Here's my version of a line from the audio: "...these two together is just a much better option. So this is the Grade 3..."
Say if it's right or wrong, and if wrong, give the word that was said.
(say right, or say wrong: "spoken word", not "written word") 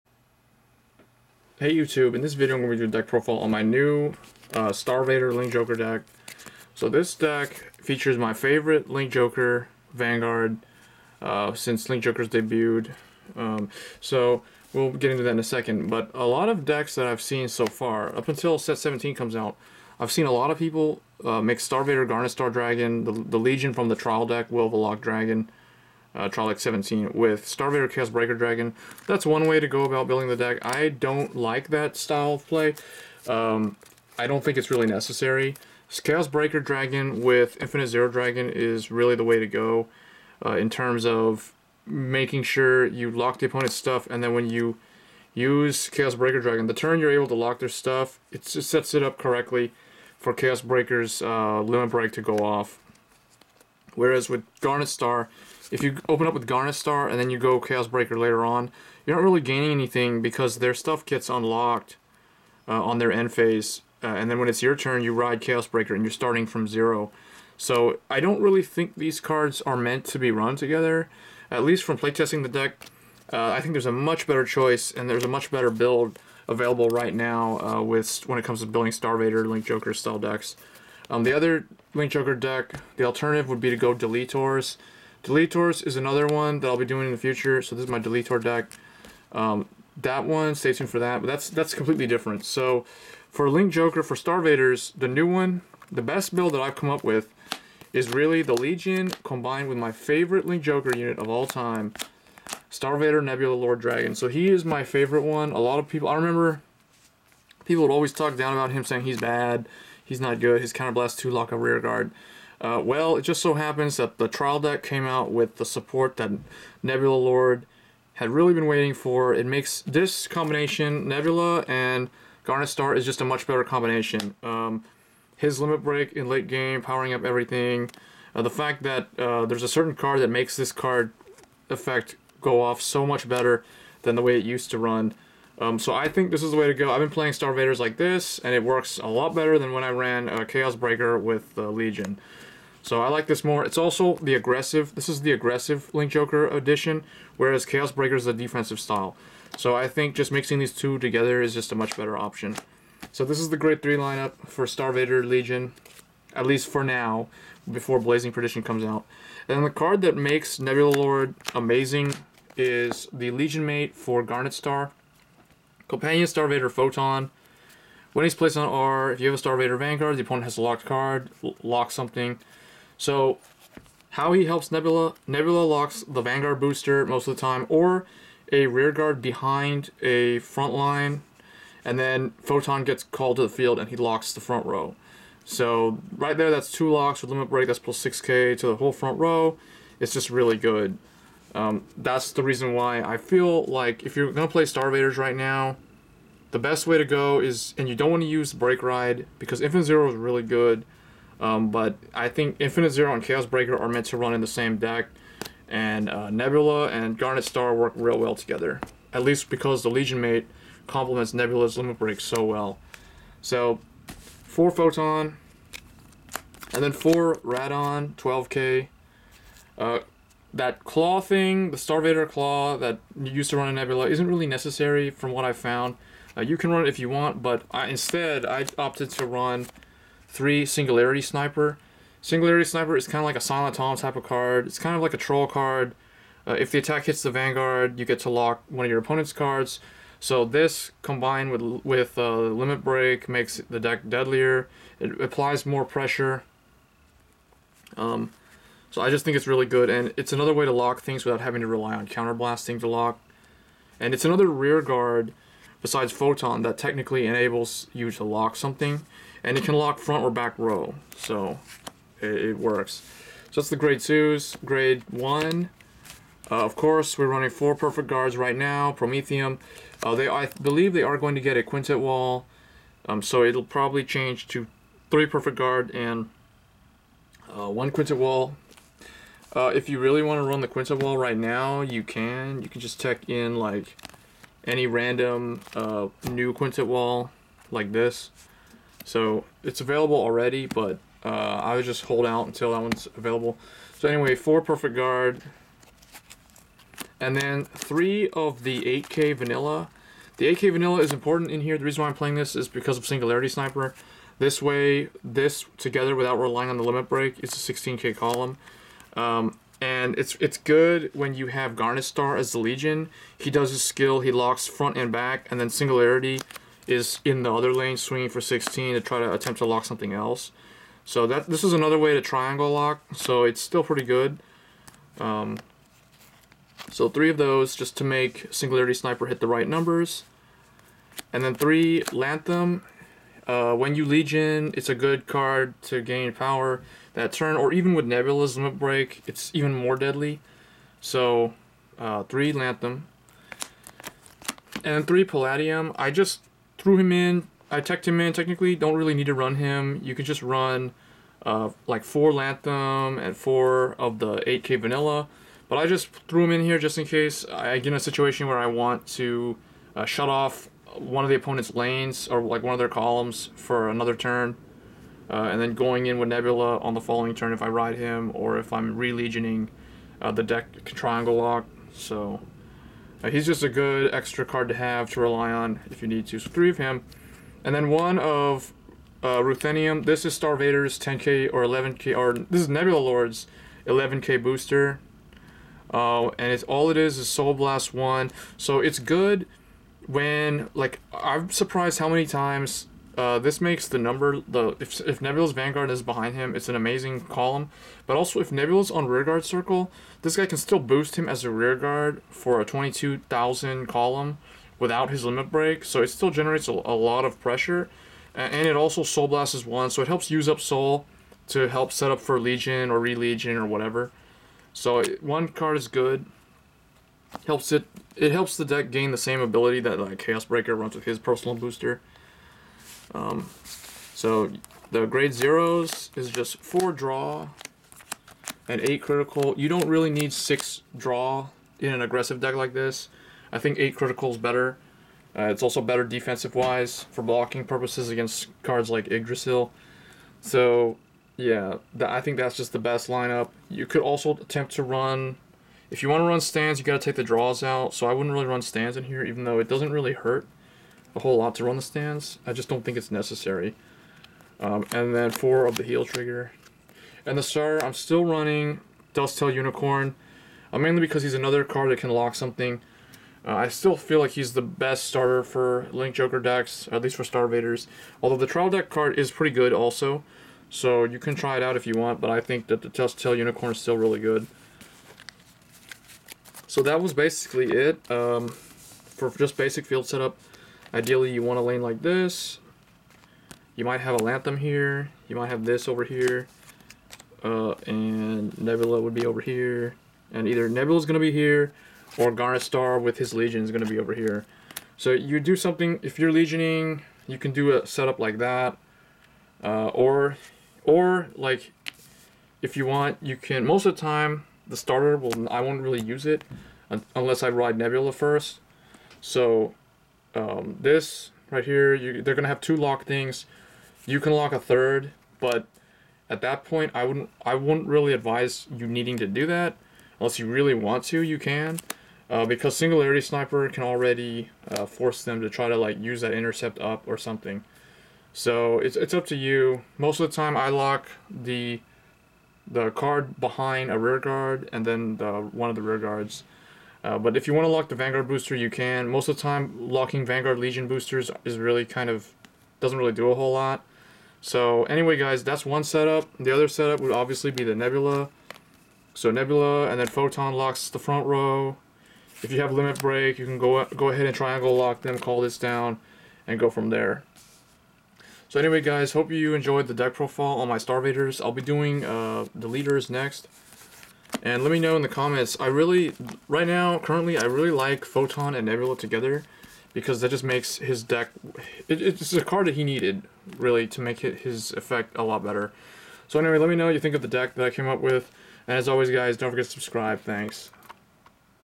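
right.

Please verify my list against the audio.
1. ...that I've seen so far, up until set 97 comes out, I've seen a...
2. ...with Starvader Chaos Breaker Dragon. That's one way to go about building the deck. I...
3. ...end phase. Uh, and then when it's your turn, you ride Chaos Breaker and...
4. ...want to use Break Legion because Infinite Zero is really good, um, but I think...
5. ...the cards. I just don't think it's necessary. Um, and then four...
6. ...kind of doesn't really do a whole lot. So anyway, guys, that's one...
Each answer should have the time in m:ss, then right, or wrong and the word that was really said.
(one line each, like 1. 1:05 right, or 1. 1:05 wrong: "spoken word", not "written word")
1. 0:16 wrong: "17", not "97"
2. 0:27 right
3. 1:03 right
4. 3:18 wrong: "Ride", not "Legion"
5. 7:31 wrong: "stands", not "cards"
6. 9:01 right.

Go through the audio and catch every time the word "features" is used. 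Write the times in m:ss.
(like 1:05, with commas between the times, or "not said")
0:07.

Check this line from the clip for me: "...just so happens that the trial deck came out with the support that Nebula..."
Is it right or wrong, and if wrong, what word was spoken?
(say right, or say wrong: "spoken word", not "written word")
right.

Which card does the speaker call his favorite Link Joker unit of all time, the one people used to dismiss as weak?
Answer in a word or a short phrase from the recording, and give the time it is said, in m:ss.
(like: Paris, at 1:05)
Starvader Nebula Lord Dragon, at 1:42.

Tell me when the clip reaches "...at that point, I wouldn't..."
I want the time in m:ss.
8:36.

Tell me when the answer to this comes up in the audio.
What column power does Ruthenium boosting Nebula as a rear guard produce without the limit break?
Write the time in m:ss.
6:42.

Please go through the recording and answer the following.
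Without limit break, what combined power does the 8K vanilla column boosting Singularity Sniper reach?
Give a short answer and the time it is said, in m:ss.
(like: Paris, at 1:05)
16K, at 5:07.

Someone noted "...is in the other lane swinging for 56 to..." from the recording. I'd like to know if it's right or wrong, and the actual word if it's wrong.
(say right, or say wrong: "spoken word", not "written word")
wrong: "16", not "56".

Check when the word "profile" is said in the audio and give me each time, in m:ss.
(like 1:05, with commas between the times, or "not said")
0:03, 9:20.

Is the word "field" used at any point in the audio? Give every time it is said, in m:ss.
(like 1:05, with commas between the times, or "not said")
3:03, 7:59.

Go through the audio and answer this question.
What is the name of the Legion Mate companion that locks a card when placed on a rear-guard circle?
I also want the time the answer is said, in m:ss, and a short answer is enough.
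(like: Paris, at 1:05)
Star Vader, Photon, at 2:46.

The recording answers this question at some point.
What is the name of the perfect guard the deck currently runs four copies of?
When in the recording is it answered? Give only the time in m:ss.
4:28.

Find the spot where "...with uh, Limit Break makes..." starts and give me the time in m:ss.
4:01.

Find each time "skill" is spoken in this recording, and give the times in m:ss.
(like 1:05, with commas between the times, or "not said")
5:13.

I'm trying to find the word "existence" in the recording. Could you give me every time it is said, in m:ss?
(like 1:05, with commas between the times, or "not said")
not said.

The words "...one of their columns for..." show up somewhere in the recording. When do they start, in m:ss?
6:02.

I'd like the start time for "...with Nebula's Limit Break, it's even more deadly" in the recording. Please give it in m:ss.
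5:37.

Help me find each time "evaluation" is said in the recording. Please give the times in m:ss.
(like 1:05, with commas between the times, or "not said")
not said.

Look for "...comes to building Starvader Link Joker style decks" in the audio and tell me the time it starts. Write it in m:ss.
1:18.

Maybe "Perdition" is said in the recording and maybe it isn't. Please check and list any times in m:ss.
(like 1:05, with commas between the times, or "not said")
2:38.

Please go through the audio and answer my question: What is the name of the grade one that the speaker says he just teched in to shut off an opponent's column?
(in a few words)
Palladium.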